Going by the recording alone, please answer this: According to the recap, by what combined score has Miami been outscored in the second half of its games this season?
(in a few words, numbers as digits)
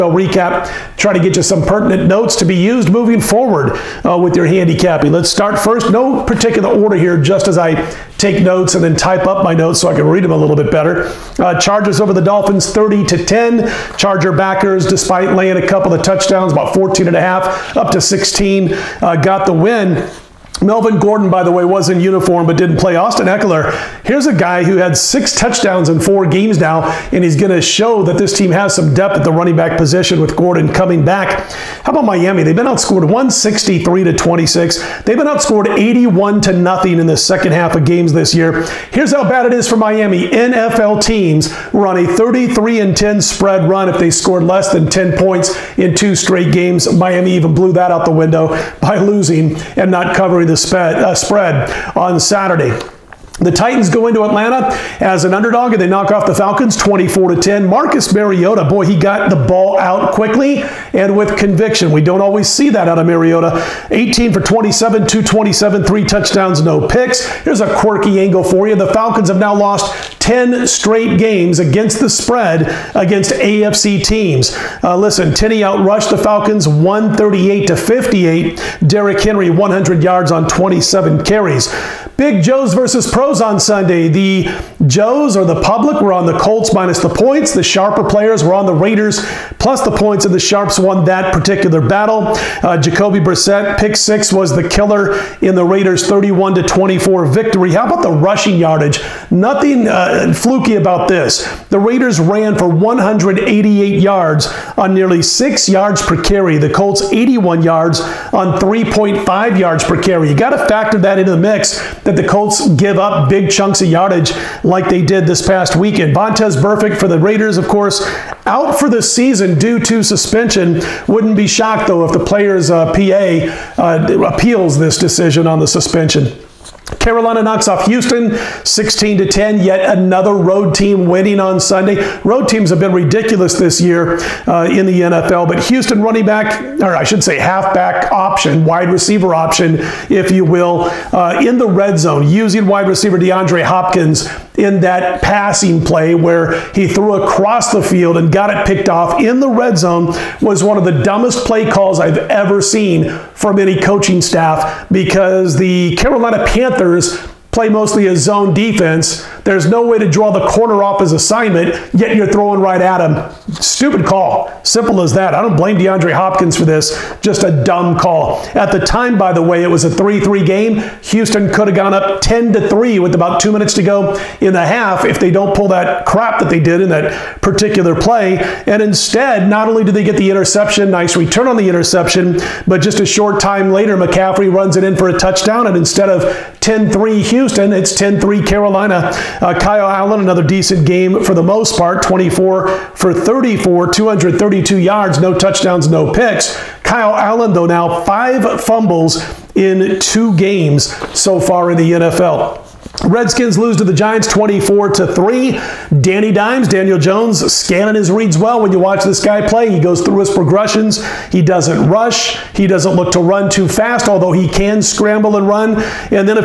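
81 to 0.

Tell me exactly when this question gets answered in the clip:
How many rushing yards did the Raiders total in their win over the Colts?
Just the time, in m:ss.
1:42.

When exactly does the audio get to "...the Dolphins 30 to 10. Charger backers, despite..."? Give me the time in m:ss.
0:12.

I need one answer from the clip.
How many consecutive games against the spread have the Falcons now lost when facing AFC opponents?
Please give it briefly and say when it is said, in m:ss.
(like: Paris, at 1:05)
10, at 1:10.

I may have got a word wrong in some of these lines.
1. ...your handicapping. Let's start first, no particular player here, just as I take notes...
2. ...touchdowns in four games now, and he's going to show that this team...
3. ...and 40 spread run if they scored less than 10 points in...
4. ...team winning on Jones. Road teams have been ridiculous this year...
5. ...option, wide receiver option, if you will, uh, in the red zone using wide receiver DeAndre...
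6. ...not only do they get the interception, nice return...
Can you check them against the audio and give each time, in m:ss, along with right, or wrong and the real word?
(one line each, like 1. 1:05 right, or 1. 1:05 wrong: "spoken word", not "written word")
1. 0:04 wrong: "order", not "player"
2. 0:25 right
3. 0:42 wrong: "10", not "40"
4. 2:10 wrong: "Sunday", not "Jones"
5. 2:18 right
6. 2:59 right.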